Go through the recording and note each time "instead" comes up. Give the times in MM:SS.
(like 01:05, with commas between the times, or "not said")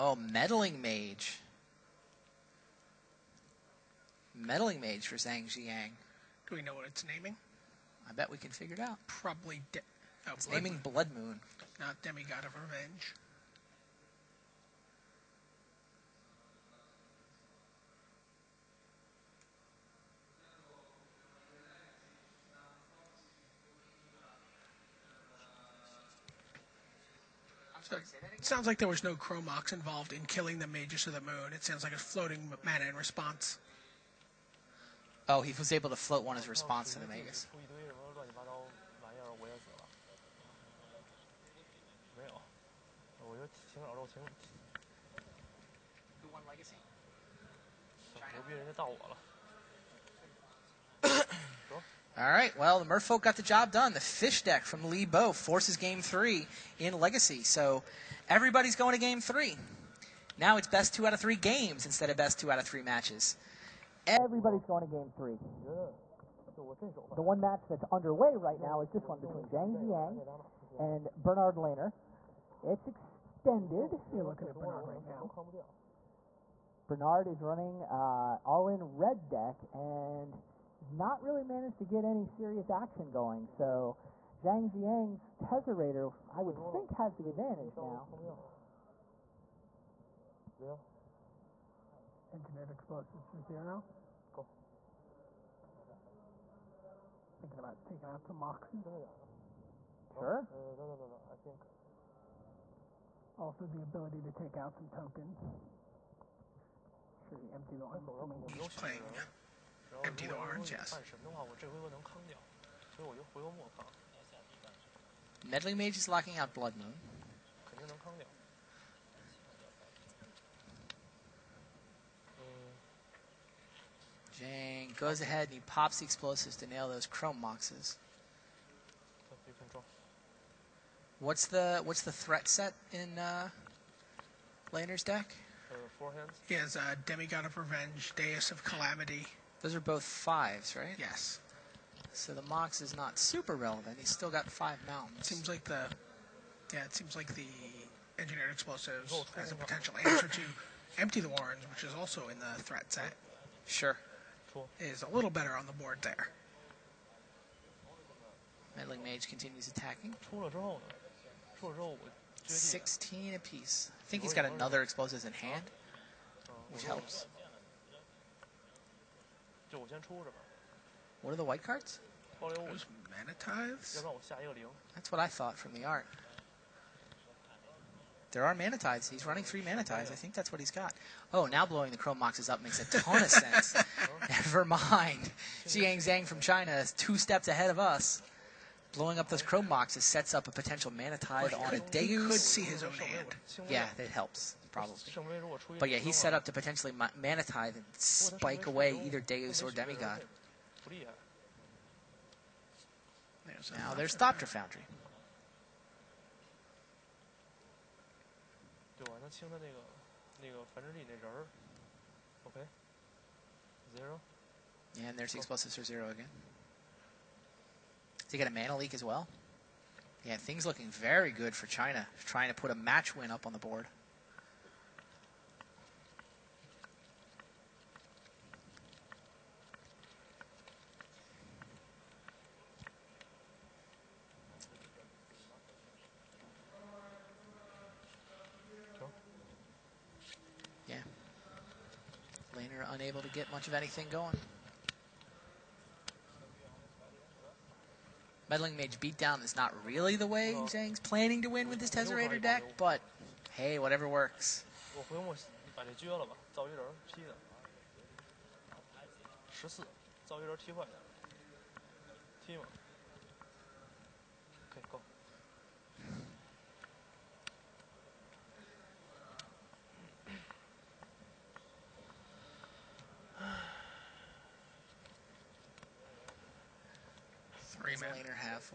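01:01.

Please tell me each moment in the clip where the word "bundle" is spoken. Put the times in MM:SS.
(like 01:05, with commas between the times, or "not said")
not said.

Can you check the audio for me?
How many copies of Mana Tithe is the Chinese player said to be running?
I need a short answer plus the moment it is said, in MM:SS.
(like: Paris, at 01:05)
3, at 02:59.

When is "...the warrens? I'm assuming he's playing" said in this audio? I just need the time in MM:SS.
01:47.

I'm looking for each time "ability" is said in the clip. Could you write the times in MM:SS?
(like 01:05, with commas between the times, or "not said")
01:43.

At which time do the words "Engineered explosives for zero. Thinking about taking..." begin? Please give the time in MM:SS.
01:32.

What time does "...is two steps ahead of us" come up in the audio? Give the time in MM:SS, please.
03:06.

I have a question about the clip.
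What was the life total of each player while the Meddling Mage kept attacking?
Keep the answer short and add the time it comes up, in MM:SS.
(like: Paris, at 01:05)
16, at 02:42.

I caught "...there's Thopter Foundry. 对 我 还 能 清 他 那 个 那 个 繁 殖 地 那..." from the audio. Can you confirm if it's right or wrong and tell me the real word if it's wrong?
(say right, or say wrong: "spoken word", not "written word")
right.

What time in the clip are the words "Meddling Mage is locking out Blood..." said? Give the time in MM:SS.
01:55.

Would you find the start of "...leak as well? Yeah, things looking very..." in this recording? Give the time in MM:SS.
03:38.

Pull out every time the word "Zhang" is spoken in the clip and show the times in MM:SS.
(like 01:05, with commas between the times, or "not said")
00:05, 01:09, 01:24, 03:05, 04:10.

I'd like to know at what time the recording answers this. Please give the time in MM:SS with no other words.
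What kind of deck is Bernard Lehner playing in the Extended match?
01:18.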